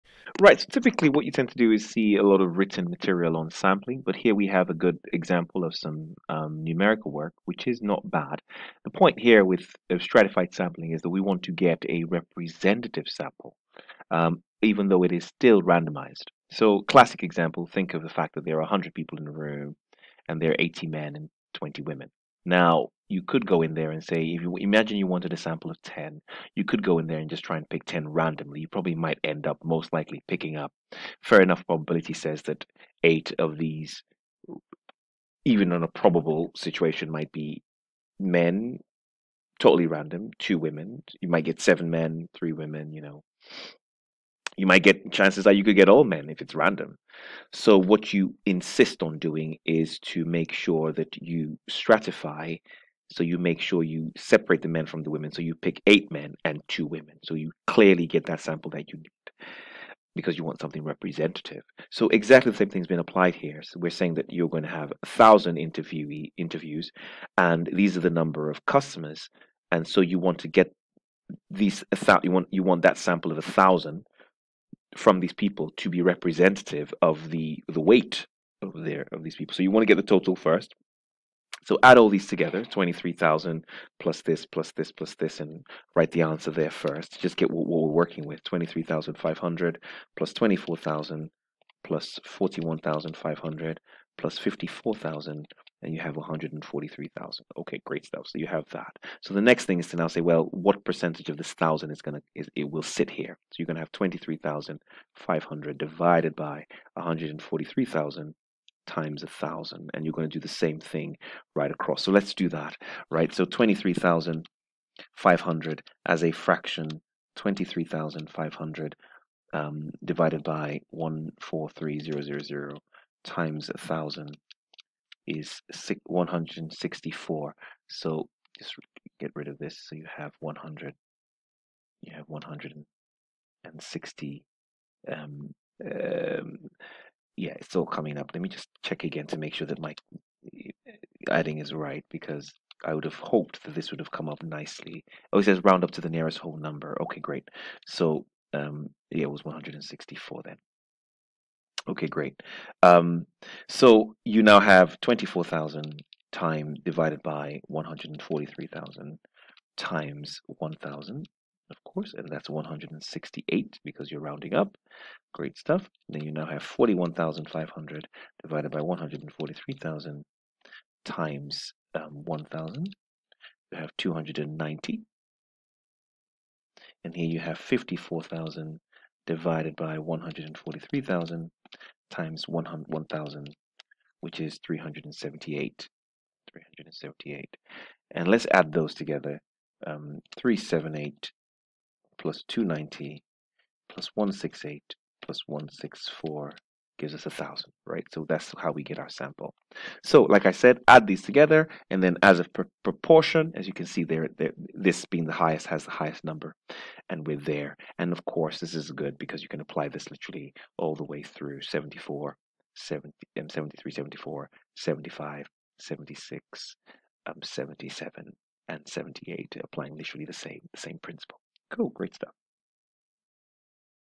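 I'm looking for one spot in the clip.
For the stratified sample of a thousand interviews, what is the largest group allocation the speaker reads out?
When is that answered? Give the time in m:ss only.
3:12.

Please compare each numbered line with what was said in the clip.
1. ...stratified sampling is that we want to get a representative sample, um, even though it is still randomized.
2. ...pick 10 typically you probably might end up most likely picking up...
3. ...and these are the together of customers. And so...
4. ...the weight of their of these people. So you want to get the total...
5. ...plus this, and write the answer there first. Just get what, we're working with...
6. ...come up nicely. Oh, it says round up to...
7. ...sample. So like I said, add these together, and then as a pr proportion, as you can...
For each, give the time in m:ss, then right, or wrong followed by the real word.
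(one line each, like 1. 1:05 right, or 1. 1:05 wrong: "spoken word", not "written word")
1. 0:09 right
2. 0:27 wrong: "randomly", not "typically"
3. 1:07 wrong: "number", not "together"
4. 1:17 right
5. 1:24 right
6. 2:24 right
7. 3:19 right.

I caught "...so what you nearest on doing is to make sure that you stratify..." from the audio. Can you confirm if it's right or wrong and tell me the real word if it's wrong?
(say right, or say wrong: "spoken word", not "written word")
wrong: "insist", not "nearest".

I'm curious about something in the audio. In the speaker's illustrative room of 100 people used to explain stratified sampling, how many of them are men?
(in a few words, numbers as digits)
80.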